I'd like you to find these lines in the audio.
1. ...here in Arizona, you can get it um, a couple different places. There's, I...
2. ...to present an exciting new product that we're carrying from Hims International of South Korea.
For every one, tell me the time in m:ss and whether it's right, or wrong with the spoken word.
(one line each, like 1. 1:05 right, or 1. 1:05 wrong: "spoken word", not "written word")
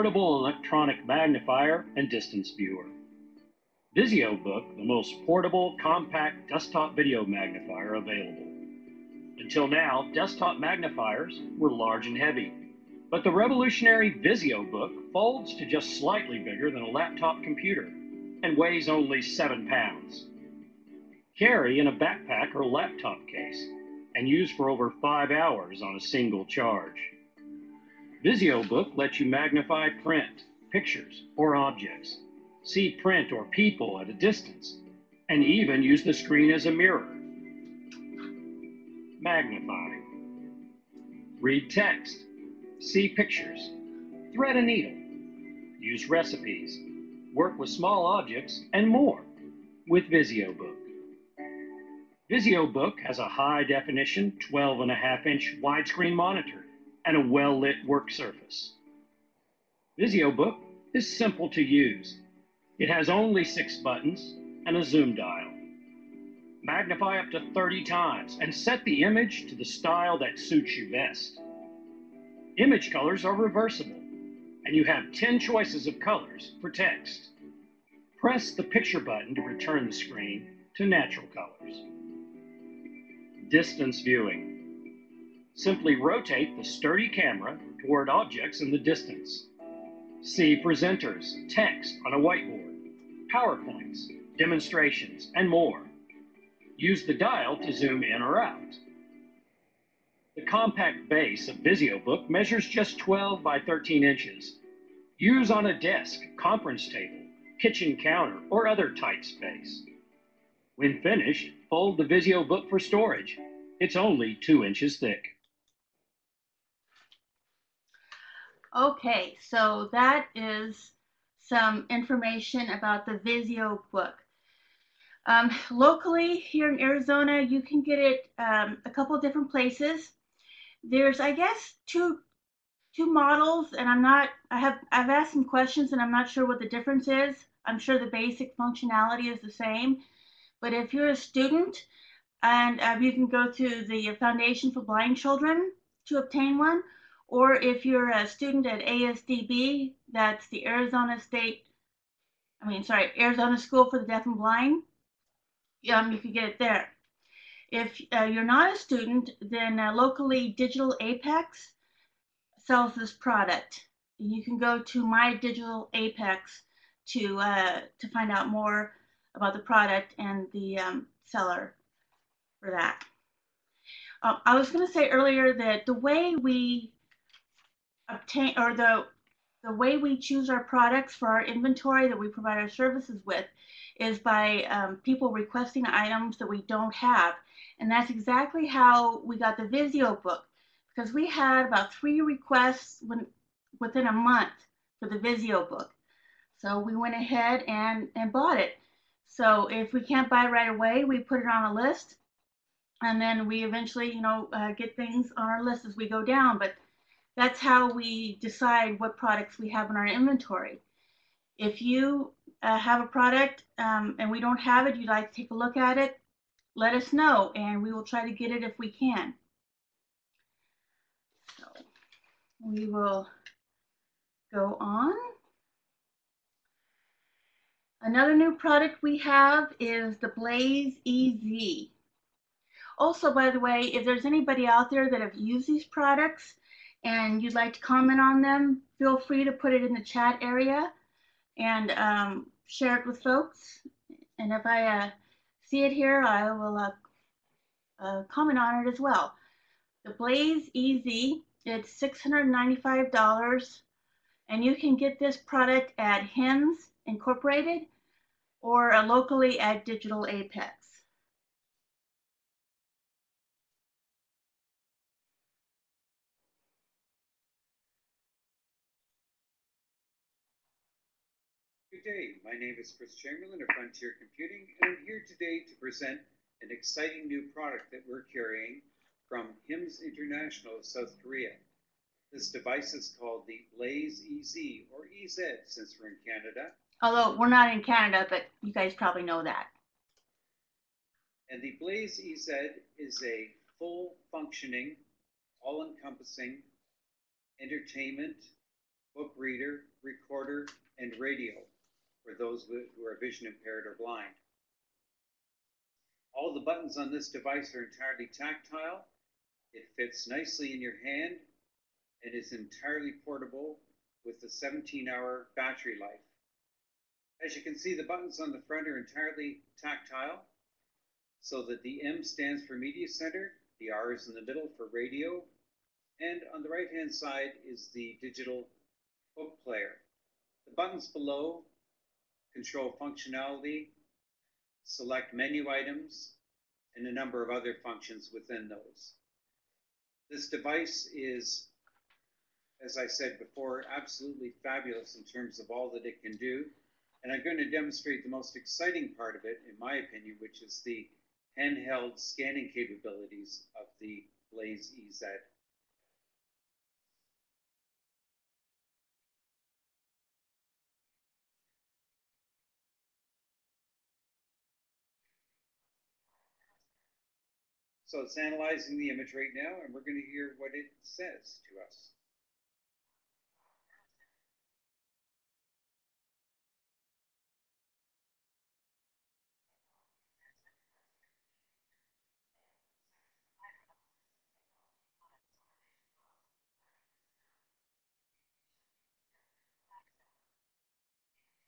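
1. 2:06 right
2. 4:35 right.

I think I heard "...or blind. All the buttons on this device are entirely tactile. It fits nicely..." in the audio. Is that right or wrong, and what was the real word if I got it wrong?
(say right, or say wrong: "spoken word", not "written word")
right.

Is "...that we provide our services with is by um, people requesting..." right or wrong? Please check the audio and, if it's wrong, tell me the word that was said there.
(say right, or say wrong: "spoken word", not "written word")
right.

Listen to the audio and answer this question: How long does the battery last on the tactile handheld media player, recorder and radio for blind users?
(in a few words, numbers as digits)
17 hours.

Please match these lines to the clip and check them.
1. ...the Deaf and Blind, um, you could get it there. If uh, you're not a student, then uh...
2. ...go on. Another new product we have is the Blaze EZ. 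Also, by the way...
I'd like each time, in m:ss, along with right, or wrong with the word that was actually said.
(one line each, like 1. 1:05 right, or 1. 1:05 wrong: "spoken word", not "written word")
1. 2:33 right
2. 3:44 right.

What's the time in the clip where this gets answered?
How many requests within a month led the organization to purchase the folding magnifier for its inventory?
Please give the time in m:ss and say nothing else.
3:11.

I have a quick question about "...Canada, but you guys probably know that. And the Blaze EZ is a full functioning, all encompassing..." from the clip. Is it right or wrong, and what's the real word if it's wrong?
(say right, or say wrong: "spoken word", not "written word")
right.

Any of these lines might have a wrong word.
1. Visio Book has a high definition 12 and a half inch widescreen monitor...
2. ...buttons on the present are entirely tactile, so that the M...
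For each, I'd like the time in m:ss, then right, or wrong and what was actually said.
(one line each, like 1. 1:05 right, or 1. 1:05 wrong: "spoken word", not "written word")
1. 0:52 right
2. 5:18 wrong: "front", not "present".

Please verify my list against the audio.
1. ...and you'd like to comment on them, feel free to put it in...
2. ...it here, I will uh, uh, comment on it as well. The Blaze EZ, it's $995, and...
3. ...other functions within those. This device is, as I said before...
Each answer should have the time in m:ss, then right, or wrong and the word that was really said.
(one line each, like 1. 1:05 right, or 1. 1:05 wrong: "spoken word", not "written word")
1. 3:57 right
2. 4:05 wrong: "695", not "995"
3. 5:37 right.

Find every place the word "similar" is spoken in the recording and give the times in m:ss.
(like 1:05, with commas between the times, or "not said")
not said.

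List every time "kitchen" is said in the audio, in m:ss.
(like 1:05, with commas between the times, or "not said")
1:47.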